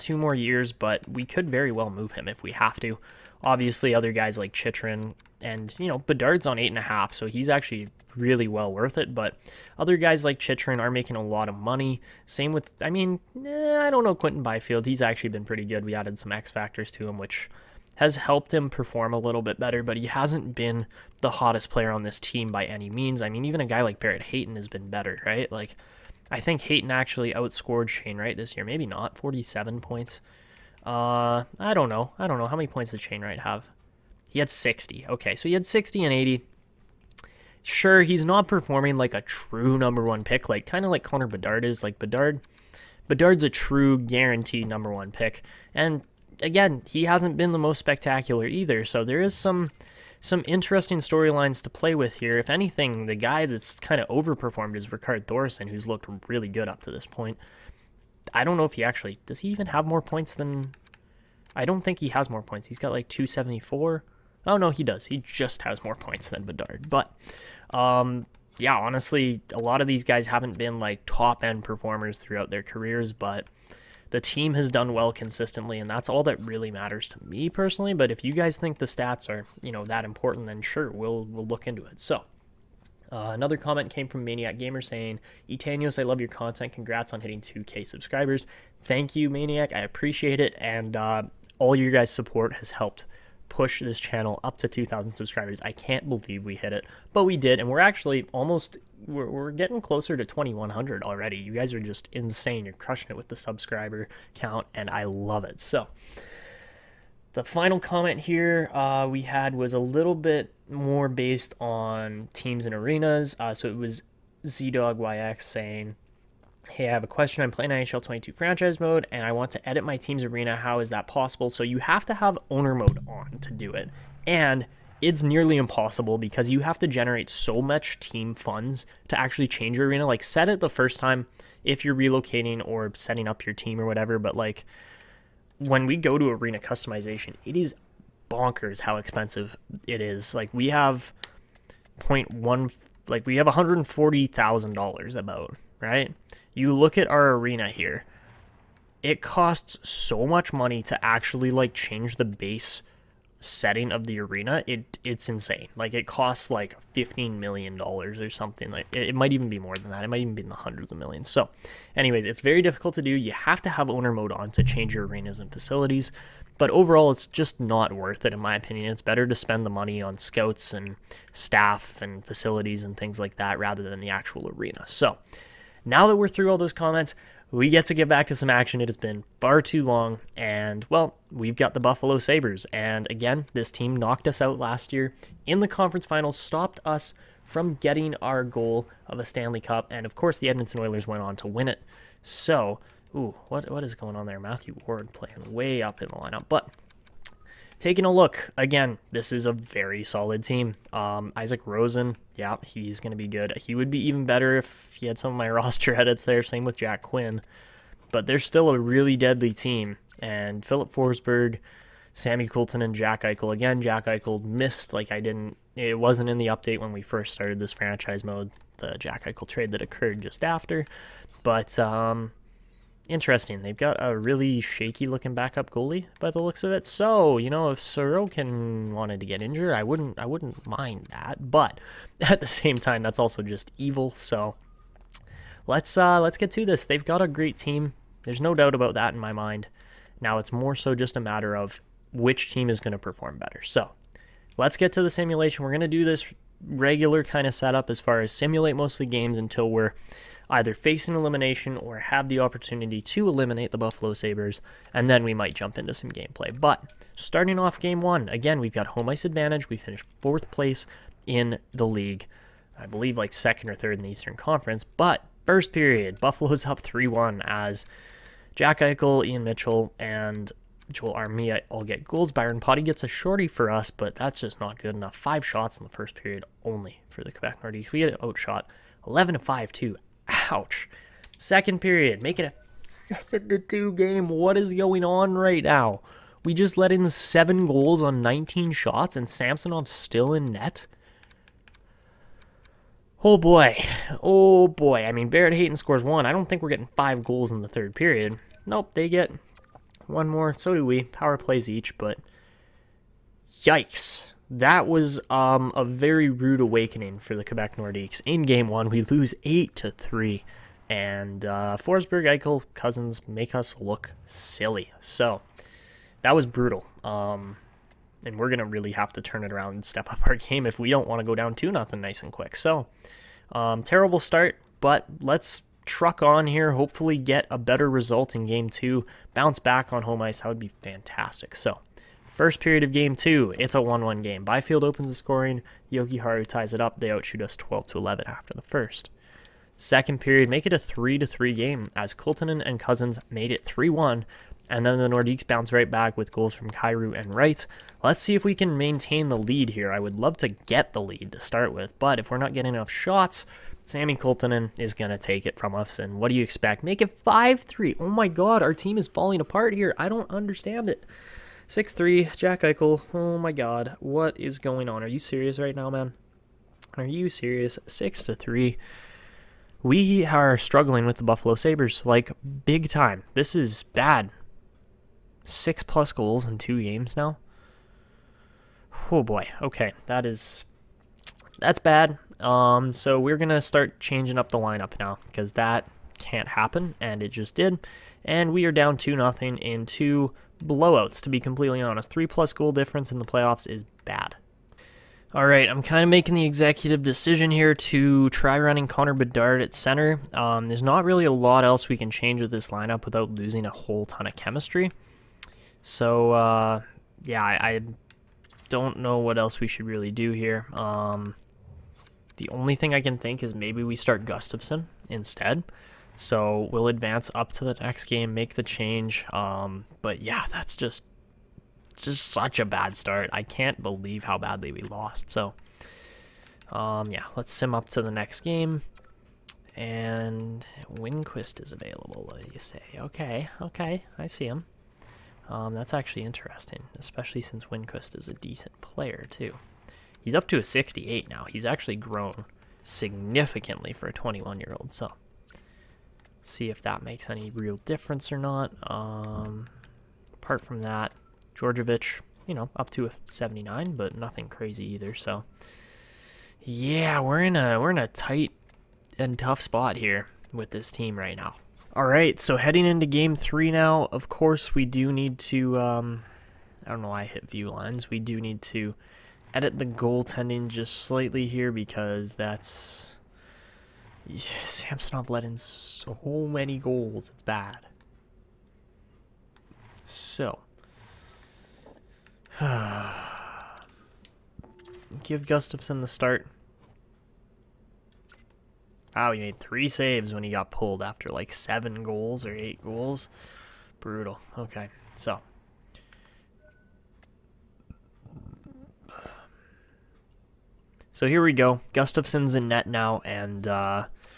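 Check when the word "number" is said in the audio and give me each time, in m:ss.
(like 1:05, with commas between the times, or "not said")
0:39, 0:44.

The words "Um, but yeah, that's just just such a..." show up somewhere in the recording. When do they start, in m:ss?
6:59.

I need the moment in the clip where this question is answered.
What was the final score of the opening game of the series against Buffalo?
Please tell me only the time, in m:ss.
5:09.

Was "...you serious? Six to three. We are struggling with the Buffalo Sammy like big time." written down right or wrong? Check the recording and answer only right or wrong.
wrong.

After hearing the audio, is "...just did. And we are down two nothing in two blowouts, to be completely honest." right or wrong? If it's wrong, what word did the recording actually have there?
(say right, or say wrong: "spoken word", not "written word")
right.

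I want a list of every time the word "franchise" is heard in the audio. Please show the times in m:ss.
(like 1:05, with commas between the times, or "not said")
1:58, 3:37.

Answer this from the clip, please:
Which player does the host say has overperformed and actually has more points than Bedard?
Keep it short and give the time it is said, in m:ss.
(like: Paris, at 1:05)
Ricard Thorson, at 0:54.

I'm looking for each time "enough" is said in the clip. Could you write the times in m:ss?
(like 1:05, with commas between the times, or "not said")
4:34, 5:52.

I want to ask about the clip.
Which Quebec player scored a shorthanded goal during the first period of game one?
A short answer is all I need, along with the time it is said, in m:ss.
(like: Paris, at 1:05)
Byron Potty, at 4:32.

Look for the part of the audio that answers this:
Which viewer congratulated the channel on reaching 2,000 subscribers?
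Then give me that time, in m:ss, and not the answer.
1:24.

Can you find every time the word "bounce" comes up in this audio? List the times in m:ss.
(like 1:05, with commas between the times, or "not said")
5:29, 5:45.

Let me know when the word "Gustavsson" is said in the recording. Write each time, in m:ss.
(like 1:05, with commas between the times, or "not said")
6:54, 8:05, 8:21.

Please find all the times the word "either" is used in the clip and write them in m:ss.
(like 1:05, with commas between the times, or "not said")
0:48, 4:10, 7:34.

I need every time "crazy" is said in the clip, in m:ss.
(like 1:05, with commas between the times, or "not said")
7:34.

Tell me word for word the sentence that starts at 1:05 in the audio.
He just has more points than Bedard.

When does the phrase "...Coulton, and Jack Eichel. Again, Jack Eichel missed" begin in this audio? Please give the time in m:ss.
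3:32.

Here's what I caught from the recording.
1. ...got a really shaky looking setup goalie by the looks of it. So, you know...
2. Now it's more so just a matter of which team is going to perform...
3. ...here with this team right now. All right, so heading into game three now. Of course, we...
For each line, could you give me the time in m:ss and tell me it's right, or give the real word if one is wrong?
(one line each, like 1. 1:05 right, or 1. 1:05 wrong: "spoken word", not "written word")
1. 3:43 wrong: "backup", not "setup"
2. 4:00 right
3. 7:39 right.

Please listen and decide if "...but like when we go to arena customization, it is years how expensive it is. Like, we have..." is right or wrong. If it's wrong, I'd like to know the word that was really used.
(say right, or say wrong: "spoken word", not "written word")
wrong: "bonkers", not "years".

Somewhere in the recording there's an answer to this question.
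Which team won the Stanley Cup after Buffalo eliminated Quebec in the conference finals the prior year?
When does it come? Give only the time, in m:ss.
3:10.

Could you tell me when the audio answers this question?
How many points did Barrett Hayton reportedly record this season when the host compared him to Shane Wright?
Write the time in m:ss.
0:29.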